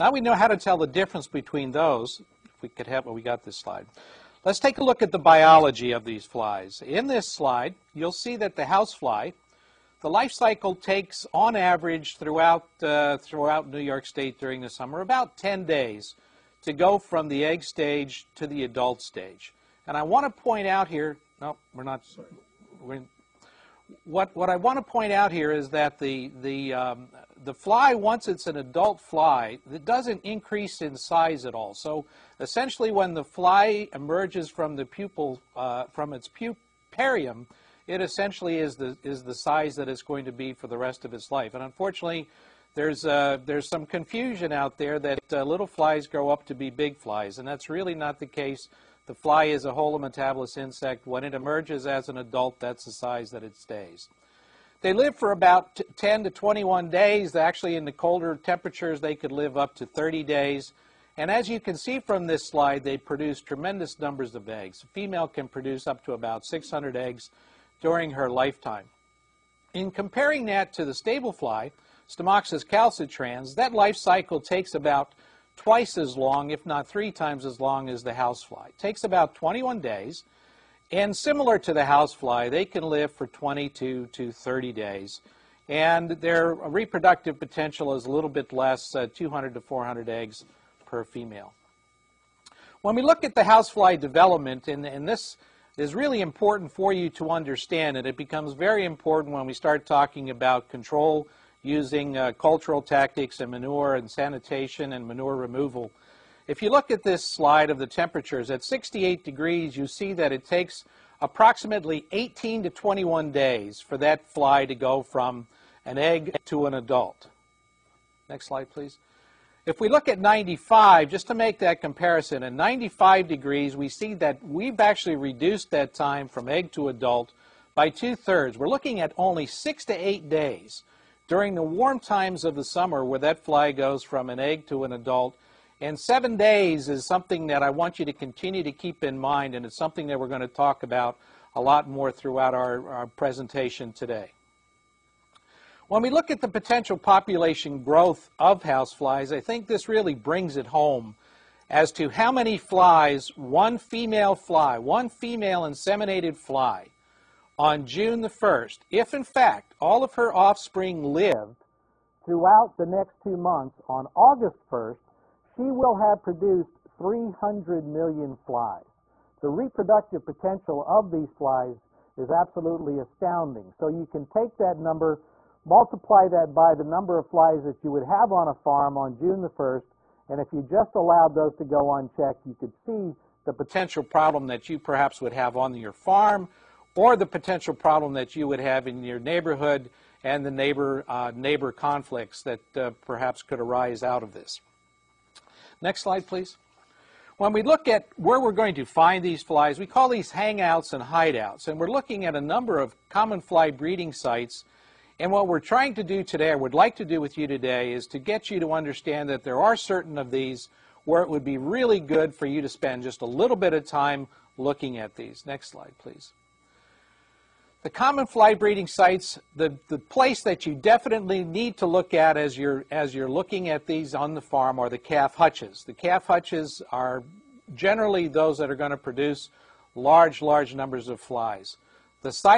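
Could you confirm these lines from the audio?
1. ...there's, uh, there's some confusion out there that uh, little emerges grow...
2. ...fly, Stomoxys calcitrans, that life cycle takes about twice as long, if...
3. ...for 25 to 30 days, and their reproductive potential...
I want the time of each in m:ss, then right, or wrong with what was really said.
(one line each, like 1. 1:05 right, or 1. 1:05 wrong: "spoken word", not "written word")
1. 0:42 wrong: "flies", not "emerges"
2. 1:11 right
3. 1:23 wrong: "22", not "25".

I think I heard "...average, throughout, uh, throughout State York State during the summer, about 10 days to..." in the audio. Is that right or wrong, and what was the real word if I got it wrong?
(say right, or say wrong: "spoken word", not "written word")
wrong: "New", not "State".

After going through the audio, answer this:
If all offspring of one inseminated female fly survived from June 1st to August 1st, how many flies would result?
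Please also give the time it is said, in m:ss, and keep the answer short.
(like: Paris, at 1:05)
300 million, at 2:46.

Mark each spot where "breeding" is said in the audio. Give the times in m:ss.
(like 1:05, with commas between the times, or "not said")
3:23, 3:38.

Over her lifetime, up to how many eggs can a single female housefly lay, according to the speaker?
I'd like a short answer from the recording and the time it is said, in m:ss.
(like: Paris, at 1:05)
600, at 1:06.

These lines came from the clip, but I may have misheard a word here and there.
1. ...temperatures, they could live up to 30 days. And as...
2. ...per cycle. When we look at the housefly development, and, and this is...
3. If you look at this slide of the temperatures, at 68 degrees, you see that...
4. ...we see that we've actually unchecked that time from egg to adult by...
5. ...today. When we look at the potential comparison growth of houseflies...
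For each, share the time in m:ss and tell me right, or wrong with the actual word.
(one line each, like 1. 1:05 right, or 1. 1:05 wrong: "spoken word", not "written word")
1. 0:58 right
2. 1:30 wrong: "female", not "cycle"
3. 1:46 right
4. 2:03 wrong: "reduced", not "unchecked"
5. 2:23 wrong: "population", not "comparison".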